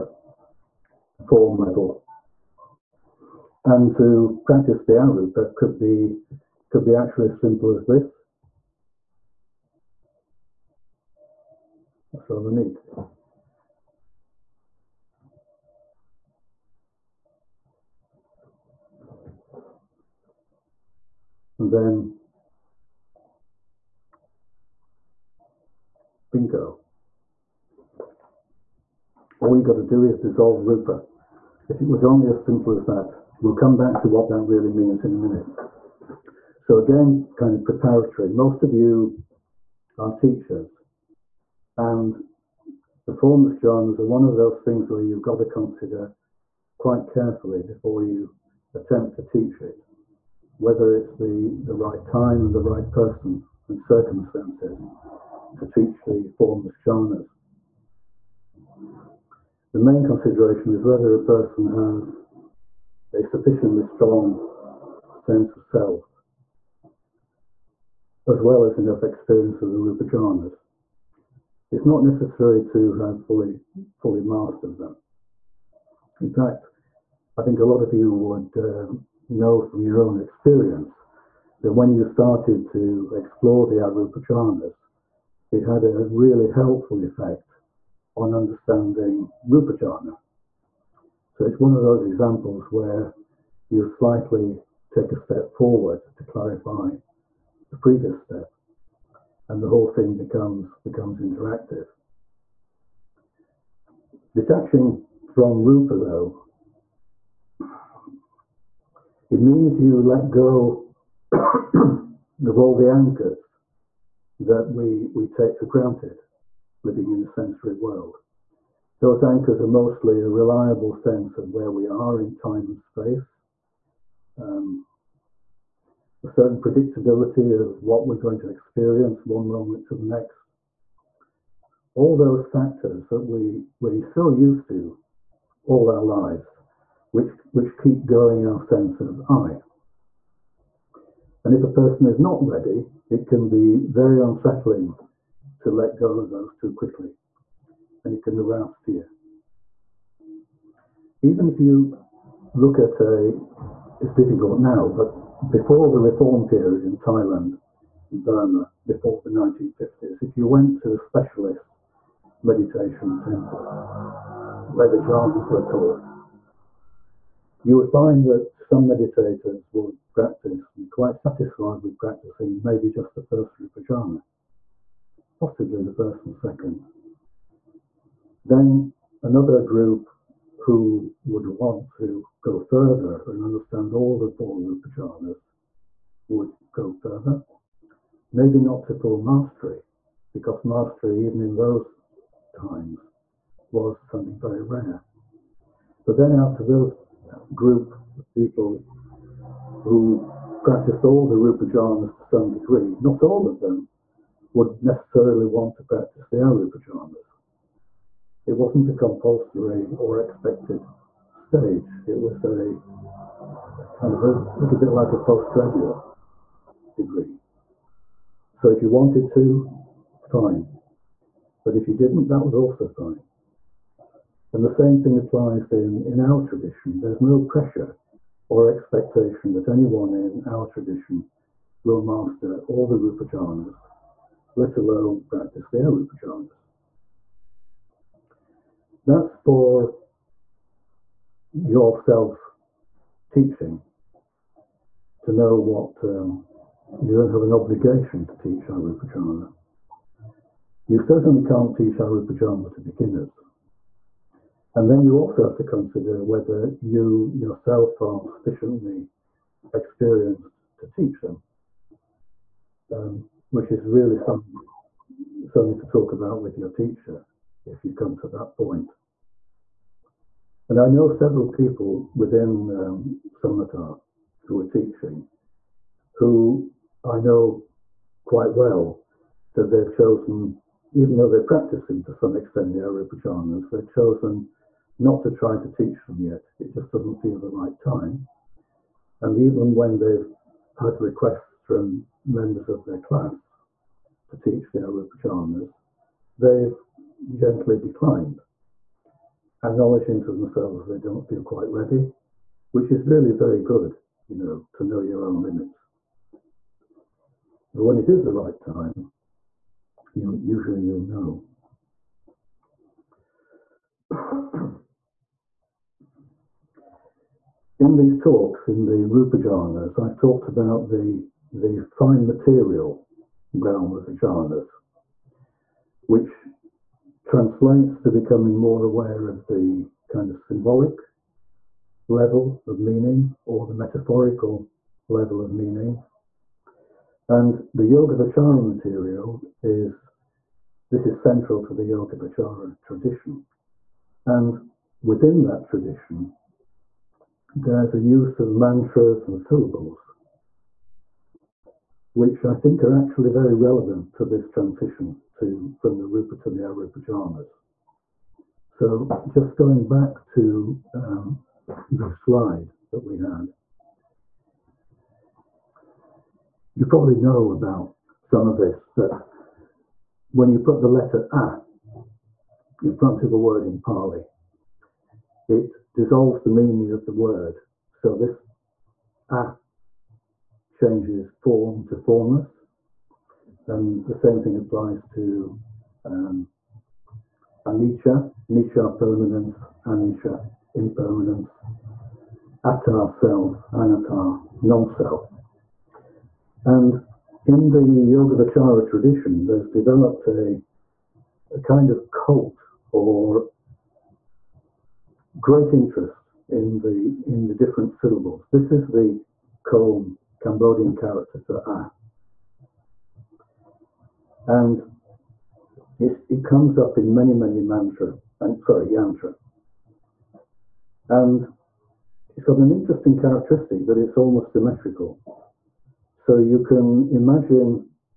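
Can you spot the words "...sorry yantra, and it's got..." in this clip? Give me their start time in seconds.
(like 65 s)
418 s.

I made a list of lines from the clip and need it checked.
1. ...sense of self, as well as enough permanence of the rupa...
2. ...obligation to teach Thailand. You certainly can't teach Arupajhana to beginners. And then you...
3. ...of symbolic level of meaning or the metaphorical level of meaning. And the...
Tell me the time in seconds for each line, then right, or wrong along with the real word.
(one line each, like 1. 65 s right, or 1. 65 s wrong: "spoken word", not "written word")
1. 65 s wrong: "experience", not "permanence"
2. 247 s wrong: "Arupajhana", not "Thailand"
3. 330 s right.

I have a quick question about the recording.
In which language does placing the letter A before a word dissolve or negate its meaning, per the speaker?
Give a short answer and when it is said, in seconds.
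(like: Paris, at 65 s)
Pali, at 373 s.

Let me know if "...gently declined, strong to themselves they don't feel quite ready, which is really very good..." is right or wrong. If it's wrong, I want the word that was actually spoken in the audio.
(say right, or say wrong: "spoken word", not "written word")
wrong: "acknowledging", not "strong".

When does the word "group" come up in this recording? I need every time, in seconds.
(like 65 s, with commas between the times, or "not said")
179 s, 197 s.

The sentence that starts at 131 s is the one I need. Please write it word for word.
All those factors that we, we're so used to all our lives, which, which keep going our sense of I.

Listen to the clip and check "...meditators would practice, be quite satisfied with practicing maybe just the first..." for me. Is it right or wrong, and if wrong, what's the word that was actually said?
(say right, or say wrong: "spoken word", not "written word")
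right.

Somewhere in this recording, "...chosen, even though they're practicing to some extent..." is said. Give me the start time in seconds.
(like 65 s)
279 s.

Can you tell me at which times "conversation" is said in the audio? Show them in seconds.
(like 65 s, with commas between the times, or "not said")
not said.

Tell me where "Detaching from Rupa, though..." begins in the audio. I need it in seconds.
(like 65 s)
104 s.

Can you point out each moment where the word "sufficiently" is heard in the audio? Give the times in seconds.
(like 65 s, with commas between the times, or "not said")
63 s, 258 s.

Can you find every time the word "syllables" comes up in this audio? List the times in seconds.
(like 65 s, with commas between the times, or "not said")
349 s, 407 s.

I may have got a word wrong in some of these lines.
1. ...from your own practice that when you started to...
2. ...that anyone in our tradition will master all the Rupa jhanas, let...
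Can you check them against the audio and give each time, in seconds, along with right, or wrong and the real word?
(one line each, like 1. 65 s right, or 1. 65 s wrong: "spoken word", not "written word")
1. 79 s wrong: "experience", not "practice"
2. 229 s right.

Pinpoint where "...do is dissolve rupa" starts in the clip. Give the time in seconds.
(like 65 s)
29 s.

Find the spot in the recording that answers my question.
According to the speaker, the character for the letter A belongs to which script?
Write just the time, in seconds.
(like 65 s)
409 s.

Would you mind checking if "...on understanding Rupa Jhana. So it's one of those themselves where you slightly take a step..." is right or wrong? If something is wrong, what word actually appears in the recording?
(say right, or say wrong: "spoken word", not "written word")
wrong: "examples", not "themselves".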